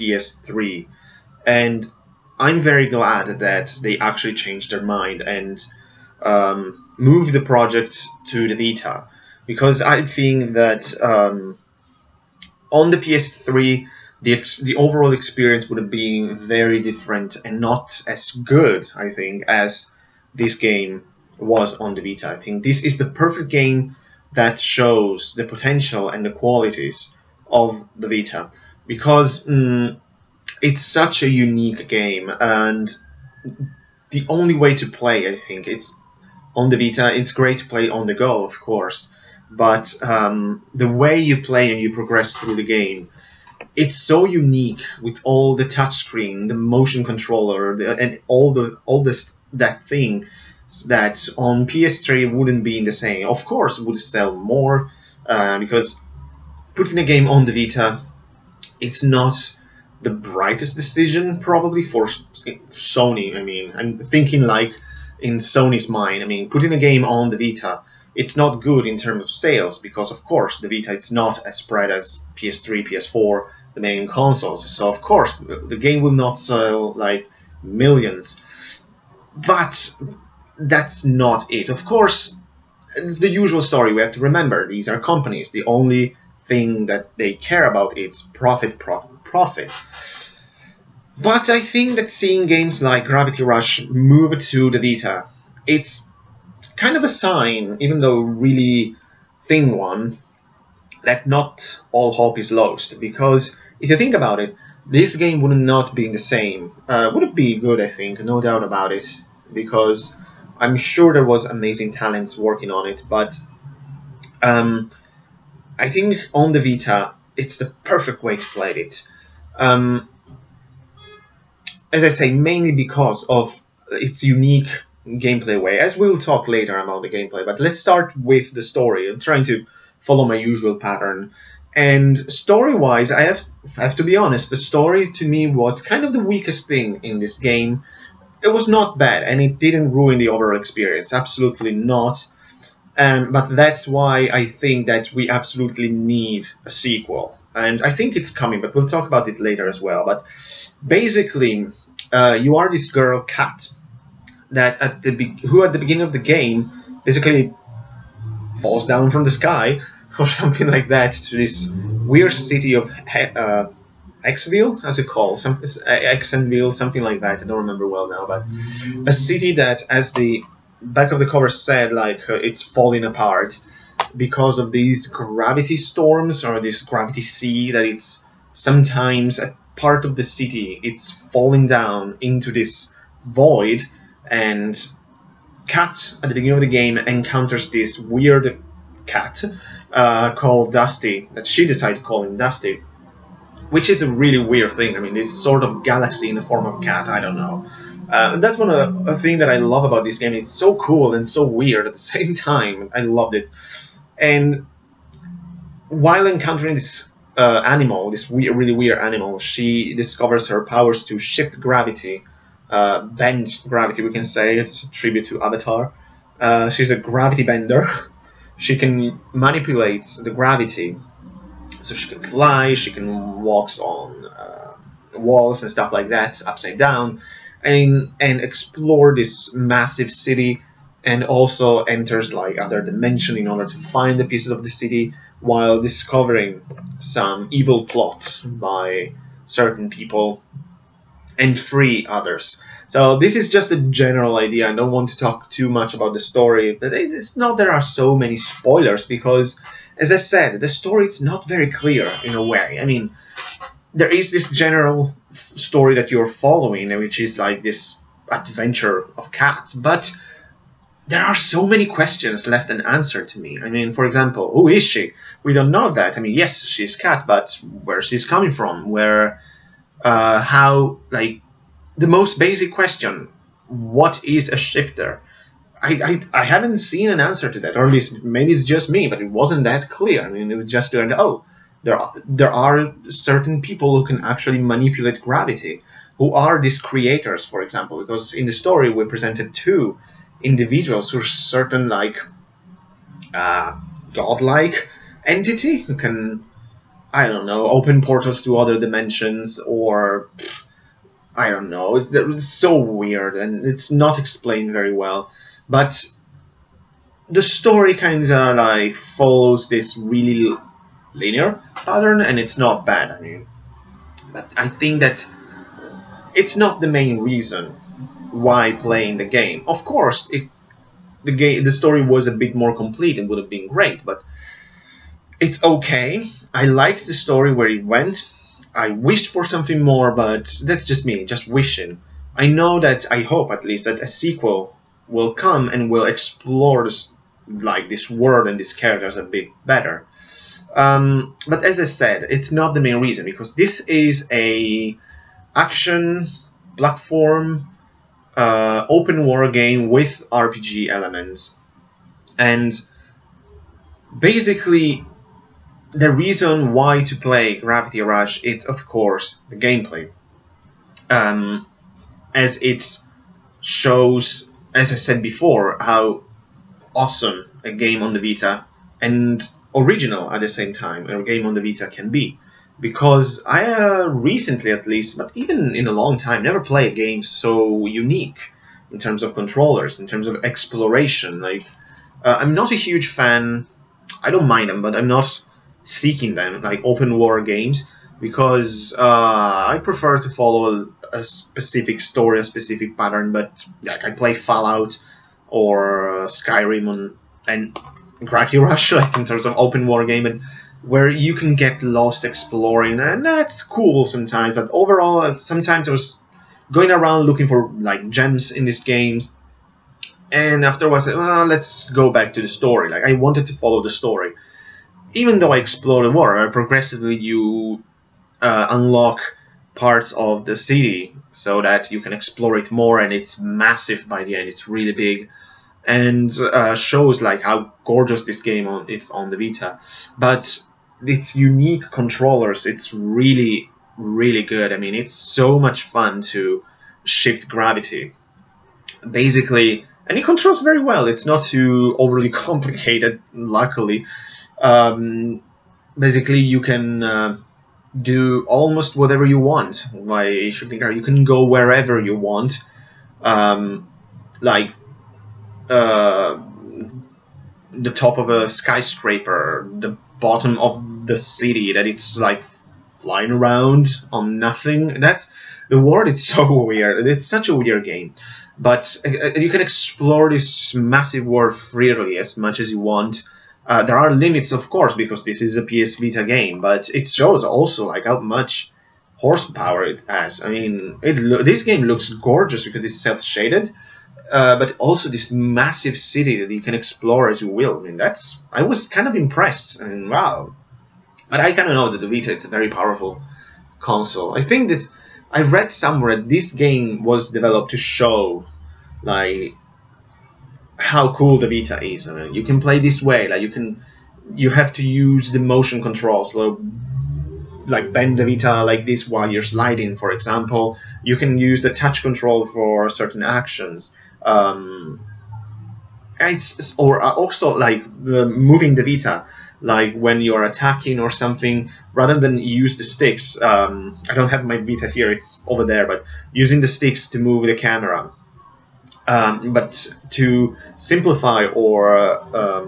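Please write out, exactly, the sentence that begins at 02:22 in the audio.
Um, but that's why I think that we absolutely need a sequel.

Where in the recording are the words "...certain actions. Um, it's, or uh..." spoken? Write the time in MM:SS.
08:32.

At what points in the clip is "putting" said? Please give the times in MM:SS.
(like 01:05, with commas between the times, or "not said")
00:56, 01:06.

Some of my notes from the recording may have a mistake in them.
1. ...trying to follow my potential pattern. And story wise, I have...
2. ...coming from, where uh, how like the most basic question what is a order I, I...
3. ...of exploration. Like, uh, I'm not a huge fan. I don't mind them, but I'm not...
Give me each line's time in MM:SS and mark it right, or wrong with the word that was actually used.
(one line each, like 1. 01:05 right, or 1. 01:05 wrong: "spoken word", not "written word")
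1. 02:09 wrong: "usual", not "potential"
2. 04:28 wrong: "shifter", not "order"
3. 06:20 right.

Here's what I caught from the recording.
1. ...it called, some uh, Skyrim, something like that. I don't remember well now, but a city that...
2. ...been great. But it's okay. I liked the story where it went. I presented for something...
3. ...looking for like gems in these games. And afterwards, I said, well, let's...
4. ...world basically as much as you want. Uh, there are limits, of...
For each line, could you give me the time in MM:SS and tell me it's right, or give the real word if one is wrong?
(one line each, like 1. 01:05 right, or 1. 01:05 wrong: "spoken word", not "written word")
1. 02:44 wrong: "Xenville", not "Skyrim"
2. 05:23 wrong: "wished", not "presented"
3. 06:47 right
4. 07:51 wrong: "freely", not "basically".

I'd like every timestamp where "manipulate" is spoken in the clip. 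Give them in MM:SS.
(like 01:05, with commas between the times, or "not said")
03:39, 04:44.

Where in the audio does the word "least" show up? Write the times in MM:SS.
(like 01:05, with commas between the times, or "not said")
04:37, 05:33, 06:14.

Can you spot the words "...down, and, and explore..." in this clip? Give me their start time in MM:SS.
03:46.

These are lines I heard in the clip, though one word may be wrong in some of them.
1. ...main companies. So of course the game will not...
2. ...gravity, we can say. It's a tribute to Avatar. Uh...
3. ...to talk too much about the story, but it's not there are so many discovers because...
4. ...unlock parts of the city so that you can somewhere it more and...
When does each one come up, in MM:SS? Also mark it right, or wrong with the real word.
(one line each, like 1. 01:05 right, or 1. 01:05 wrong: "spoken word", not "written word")
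1. 01:13 wrong: "consoles", not "companies"
2. 03:33 right
3. 04:05 wrong: "spoilers", not "discovers"
4. 06:58 wrong: "explore", not "somewhere".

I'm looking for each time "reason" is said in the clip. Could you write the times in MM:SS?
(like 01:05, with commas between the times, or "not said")
05:17, 05:43, 05:56.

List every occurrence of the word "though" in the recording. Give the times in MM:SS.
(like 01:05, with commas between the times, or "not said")
01:38, 06:55.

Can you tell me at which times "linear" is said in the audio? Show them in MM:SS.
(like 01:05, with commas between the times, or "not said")
05:11.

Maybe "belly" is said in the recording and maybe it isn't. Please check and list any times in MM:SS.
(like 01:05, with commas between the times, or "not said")
not said.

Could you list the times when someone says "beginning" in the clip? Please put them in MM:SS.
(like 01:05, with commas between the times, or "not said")
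02:35, 03:06.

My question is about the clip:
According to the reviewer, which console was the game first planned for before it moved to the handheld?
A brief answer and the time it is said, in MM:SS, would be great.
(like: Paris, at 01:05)
PS3, at 00:12.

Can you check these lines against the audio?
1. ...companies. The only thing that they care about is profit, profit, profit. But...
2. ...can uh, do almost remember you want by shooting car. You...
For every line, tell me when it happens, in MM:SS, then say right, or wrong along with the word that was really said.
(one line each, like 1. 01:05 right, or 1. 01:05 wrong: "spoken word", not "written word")
1. 01:24 right
2. 07:26 wrong: "whatever", not "remember".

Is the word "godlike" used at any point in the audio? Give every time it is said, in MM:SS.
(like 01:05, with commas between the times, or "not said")
04:54.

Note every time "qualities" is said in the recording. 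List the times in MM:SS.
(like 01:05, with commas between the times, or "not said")
00:26.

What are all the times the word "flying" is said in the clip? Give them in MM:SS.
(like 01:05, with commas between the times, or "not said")
07:43.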